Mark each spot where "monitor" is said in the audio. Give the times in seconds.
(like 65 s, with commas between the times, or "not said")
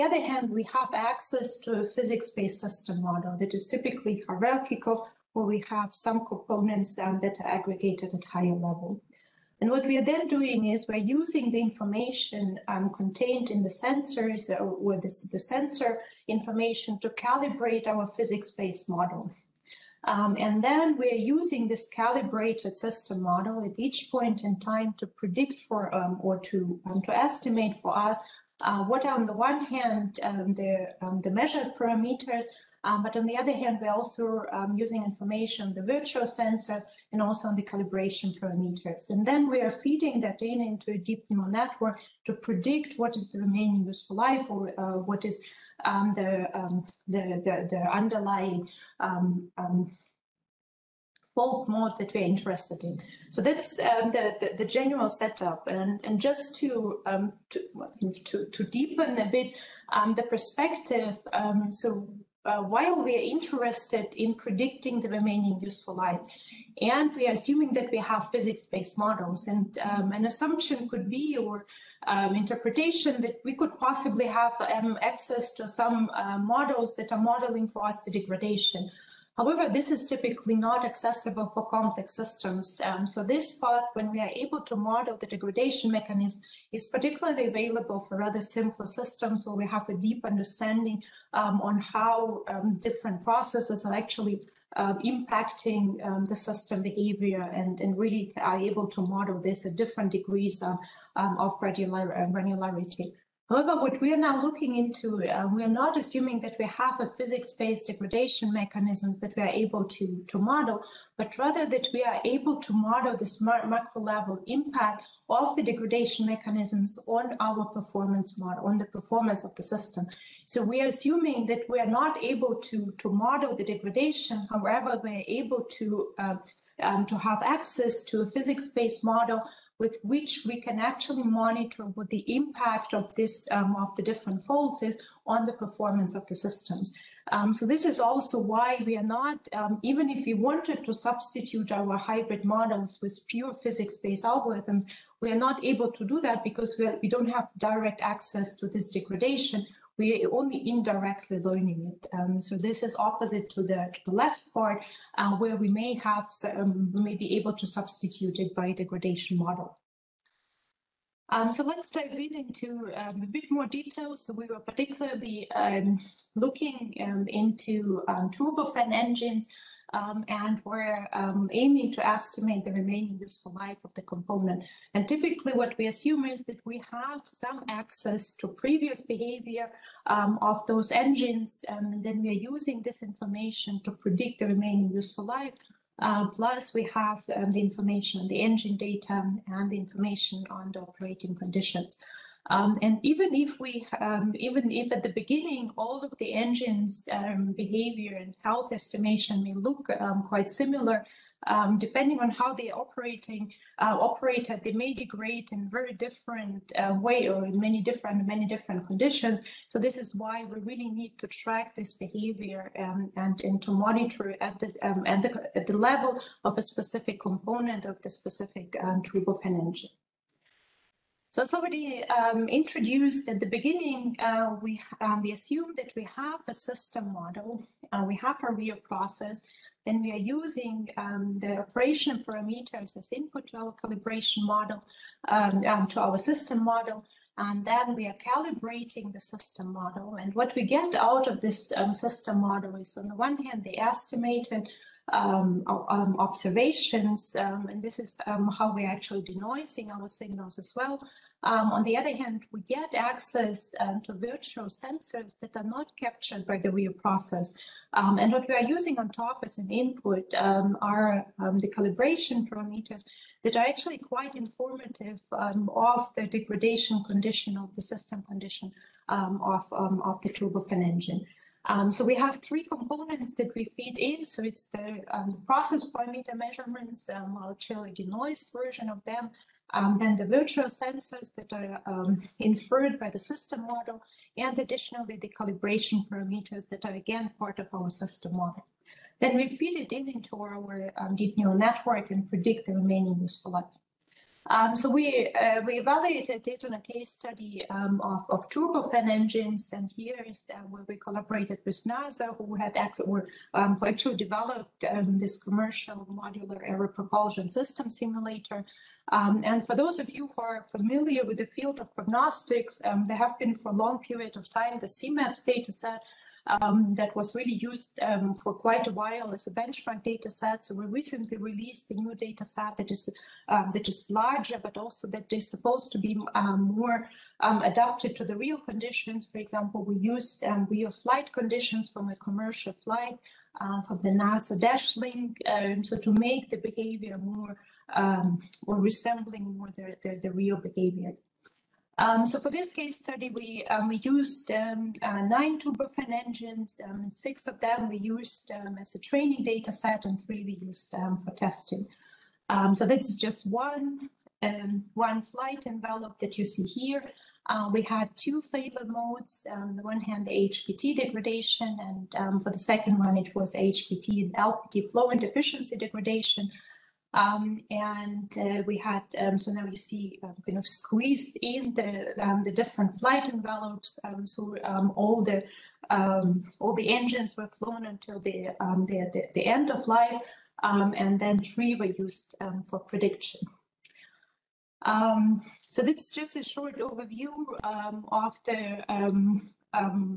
131 s, 213 s.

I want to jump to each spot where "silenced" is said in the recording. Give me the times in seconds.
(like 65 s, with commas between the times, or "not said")
not said.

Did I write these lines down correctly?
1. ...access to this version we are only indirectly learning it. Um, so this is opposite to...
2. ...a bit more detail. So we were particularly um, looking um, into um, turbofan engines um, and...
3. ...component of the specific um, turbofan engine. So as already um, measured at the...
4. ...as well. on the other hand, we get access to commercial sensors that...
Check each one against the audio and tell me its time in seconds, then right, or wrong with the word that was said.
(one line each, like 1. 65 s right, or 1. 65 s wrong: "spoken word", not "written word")
1. 147 s wrong: "degradation", not "version"
2. 163 s right
3. 217 s wrong: "introduced", not "measured"
4. 250 s wrong: "virtual", not "commercial".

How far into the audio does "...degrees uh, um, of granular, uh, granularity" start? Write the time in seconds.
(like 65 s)
100 s.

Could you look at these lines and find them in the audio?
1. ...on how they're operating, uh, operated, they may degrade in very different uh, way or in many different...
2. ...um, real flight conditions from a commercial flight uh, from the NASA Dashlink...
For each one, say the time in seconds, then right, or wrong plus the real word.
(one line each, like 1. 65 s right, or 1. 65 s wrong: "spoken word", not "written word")
1. 202 s right
2. 330 s right.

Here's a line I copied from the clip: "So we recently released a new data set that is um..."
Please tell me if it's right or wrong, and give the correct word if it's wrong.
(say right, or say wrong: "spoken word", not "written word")
right.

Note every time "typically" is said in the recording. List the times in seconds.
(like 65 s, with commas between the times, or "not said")
3 s, 80 s, 175 s.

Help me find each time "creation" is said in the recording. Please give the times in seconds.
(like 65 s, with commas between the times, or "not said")
not said.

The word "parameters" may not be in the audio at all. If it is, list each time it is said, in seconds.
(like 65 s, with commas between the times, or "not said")
31 s, 38 s, 232 s, 262 s, 275 s, 286 s.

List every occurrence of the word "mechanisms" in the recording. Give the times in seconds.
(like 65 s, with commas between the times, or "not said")
85 s, 108 s, 116 s.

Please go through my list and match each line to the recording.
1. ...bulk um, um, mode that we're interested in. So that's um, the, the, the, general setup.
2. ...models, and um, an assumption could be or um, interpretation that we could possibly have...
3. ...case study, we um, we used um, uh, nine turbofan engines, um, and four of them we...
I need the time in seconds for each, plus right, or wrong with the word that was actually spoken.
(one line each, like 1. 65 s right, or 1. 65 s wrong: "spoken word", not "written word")
1. 48 s right
2. 68 s right
3. 342 s wrong: "six", not "four".